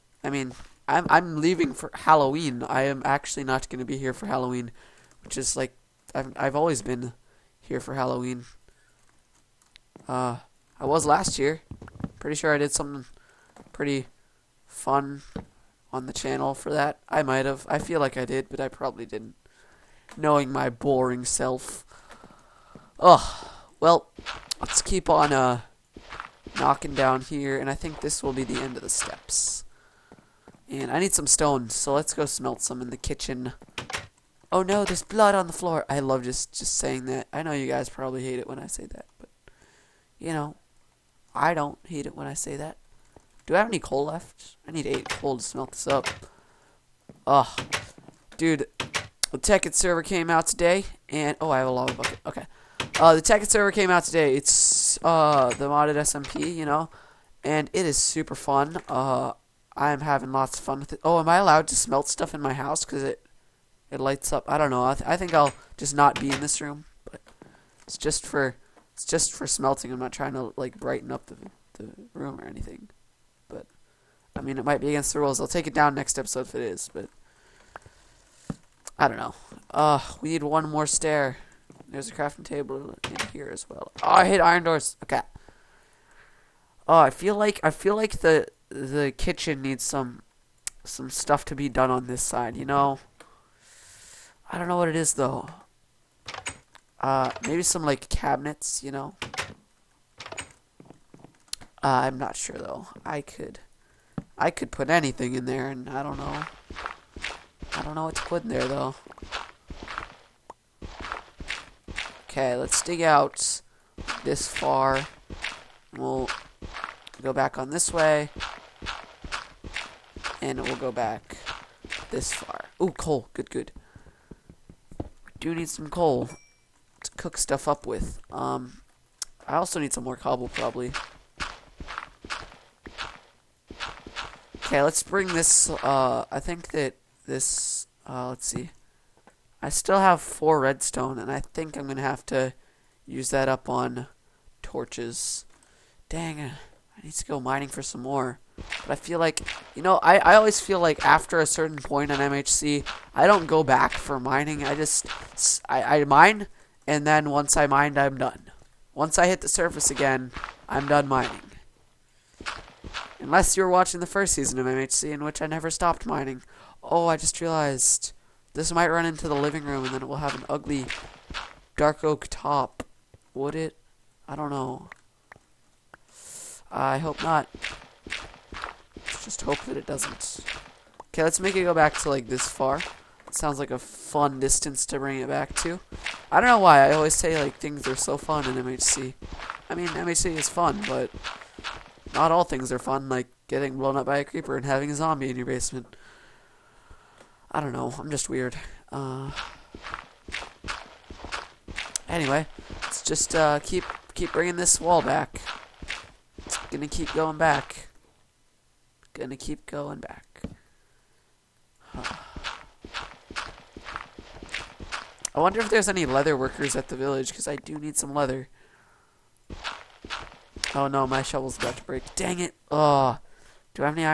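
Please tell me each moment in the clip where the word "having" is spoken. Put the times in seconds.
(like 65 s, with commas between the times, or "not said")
60 s, 194 s.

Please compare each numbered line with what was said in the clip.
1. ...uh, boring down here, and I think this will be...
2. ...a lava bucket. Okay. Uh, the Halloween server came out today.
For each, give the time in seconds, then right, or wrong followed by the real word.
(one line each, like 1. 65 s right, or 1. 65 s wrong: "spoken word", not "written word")
1. 25 s wrong: "knocking", not "boring"
2. 51 s wrong: "Tekkit", not "Halloween".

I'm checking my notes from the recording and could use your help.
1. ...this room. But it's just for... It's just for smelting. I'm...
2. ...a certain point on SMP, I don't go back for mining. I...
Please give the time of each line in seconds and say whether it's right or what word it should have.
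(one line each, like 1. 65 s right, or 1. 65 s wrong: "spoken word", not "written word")
1. 66 s right
2. 151 s wrong: "MHC", not "SMP".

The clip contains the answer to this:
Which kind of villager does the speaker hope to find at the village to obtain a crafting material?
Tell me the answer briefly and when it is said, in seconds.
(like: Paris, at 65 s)
Leather workers, at 216 s.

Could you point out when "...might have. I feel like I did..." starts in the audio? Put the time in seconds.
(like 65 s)
17 s.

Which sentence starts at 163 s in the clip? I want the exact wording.
Unless you were watching the first season of MHC, in which I never stopped mining.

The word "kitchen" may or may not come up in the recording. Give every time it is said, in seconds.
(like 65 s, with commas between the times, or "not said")
32 s, 89 s.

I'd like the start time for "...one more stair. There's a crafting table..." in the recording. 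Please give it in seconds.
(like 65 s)
80 s.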